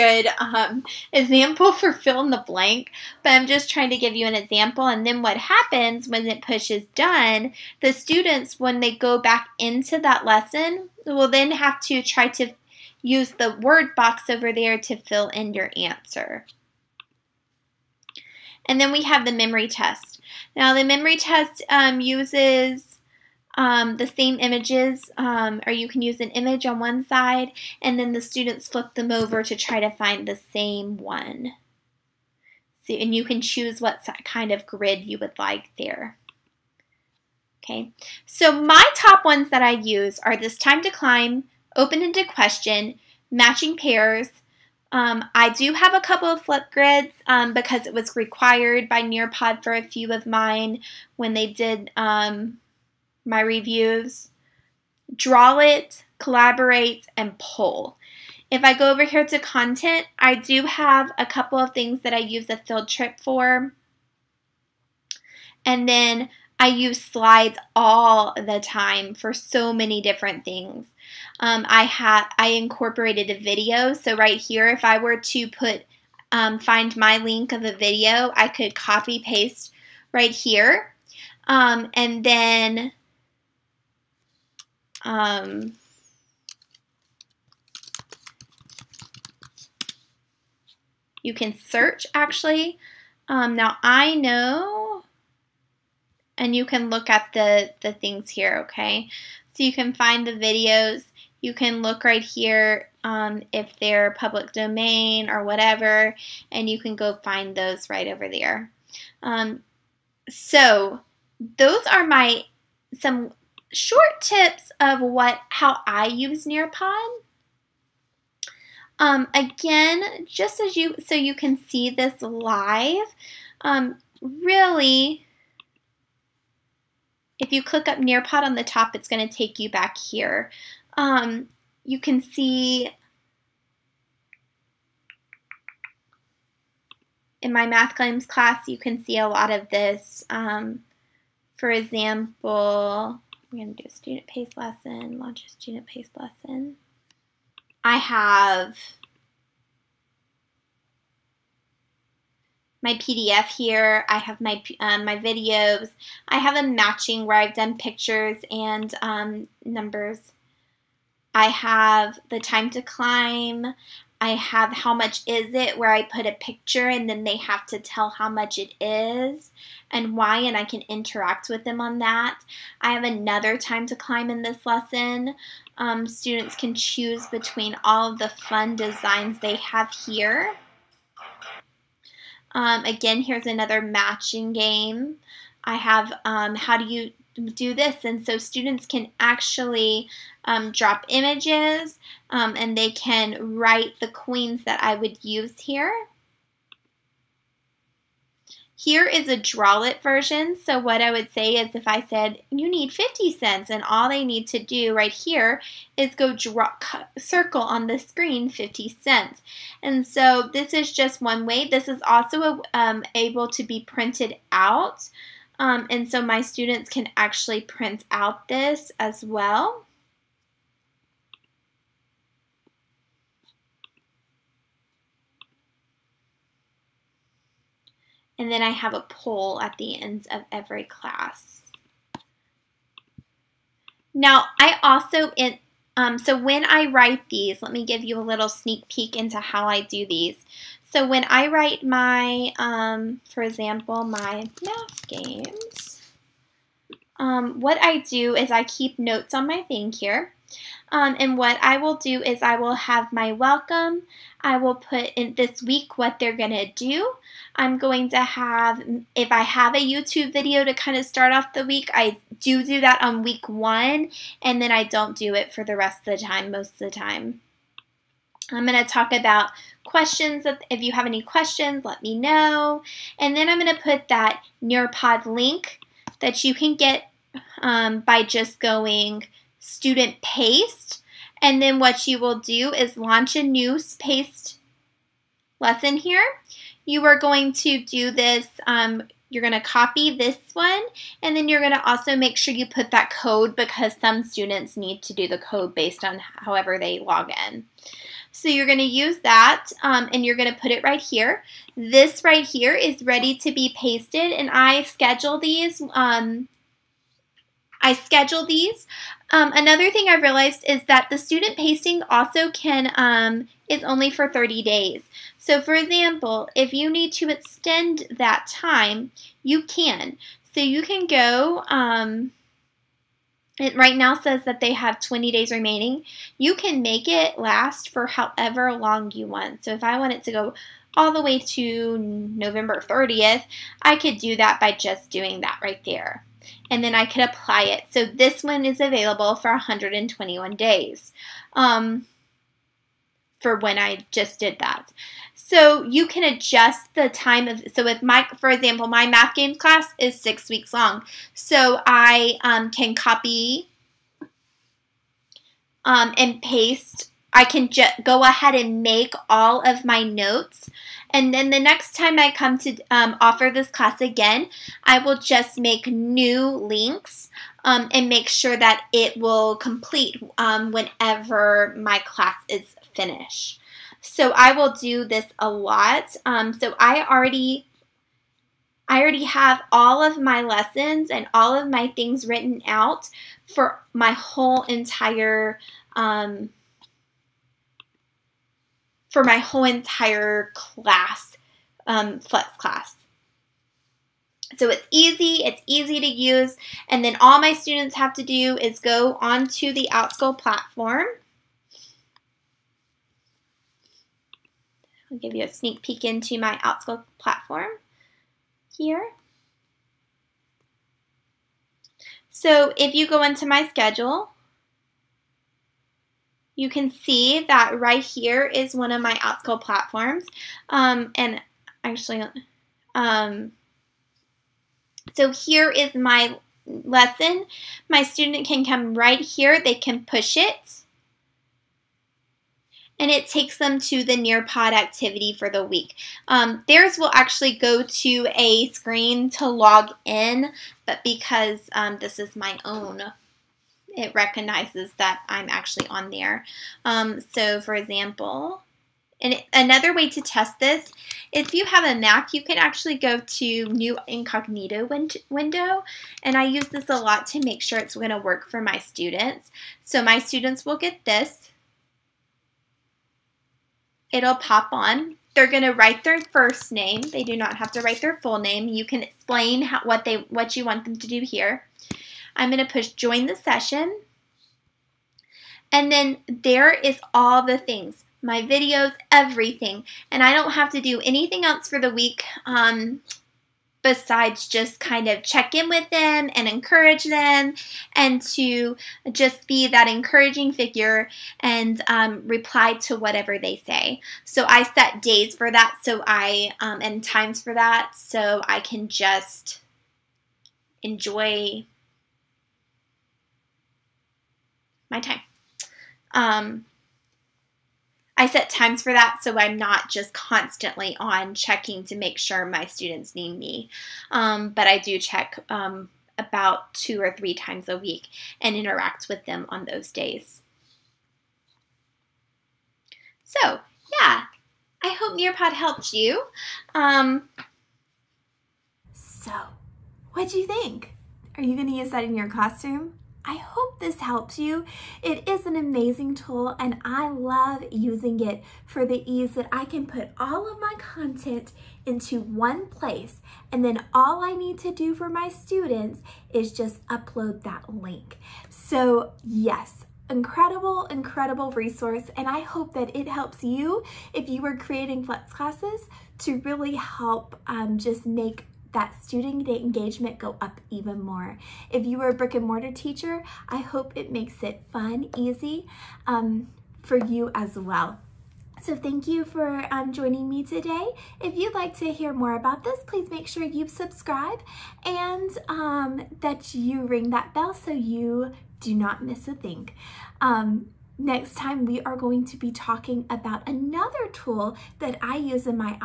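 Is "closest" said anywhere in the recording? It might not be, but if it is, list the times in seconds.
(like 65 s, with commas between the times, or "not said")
not said.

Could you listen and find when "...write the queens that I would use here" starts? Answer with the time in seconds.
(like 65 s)
193 s.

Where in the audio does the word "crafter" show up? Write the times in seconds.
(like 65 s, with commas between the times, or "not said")
not said.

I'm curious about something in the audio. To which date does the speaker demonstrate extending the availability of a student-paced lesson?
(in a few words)
November 30th.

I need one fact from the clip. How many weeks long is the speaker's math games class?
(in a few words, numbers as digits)
6.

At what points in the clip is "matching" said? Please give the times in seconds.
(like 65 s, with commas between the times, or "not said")
43 s, 156 s, 183 s.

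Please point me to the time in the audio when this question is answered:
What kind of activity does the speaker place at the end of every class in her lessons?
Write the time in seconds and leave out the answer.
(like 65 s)
229 s.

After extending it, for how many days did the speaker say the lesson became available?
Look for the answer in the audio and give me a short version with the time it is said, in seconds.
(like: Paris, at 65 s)
121 days, at 339 s.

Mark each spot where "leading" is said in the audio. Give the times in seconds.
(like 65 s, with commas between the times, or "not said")
not said.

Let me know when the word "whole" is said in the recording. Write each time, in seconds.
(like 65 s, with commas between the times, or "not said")
384 s, 389 s.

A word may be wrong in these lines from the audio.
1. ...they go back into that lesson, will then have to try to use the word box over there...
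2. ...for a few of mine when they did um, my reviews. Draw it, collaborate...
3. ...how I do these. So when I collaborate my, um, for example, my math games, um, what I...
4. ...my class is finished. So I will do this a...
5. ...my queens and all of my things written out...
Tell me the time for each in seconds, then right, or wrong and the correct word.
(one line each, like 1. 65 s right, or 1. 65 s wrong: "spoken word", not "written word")
1. 8 s right
2. 49 s right
3. 239 s wrong: "write", not "collaborate"
4. 371 s right
5. 380 s wrong: "lessons", not "queens".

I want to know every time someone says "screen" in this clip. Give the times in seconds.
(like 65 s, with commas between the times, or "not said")
207 s, 438 s.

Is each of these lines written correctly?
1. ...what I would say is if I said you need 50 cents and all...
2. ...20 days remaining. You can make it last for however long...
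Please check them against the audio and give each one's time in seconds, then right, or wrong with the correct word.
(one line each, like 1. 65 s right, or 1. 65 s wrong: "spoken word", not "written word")
1. 200 s right
2. 324 s right.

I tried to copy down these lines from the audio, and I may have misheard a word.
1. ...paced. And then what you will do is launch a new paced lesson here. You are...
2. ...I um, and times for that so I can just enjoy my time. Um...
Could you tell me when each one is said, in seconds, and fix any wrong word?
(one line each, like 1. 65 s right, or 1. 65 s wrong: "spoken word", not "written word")
1. 280 s right
2. 496 s right.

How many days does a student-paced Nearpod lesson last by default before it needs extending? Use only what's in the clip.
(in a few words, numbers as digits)
30 days.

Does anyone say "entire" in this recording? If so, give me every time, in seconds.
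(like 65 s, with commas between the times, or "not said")
384 s, 389 s.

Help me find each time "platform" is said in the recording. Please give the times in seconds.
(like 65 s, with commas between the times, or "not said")
400 s, 407 s, 419 s.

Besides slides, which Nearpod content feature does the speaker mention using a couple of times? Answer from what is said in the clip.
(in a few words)
field trip.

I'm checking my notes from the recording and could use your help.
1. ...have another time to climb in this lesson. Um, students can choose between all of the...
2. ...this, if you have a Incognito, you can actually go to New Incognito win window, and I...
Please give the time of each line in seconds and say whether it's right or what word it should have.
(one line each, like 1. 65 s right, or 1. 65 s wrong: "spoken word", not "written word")
1. 172 s right
2. 450 s wrong: "Mac", not "Incognito".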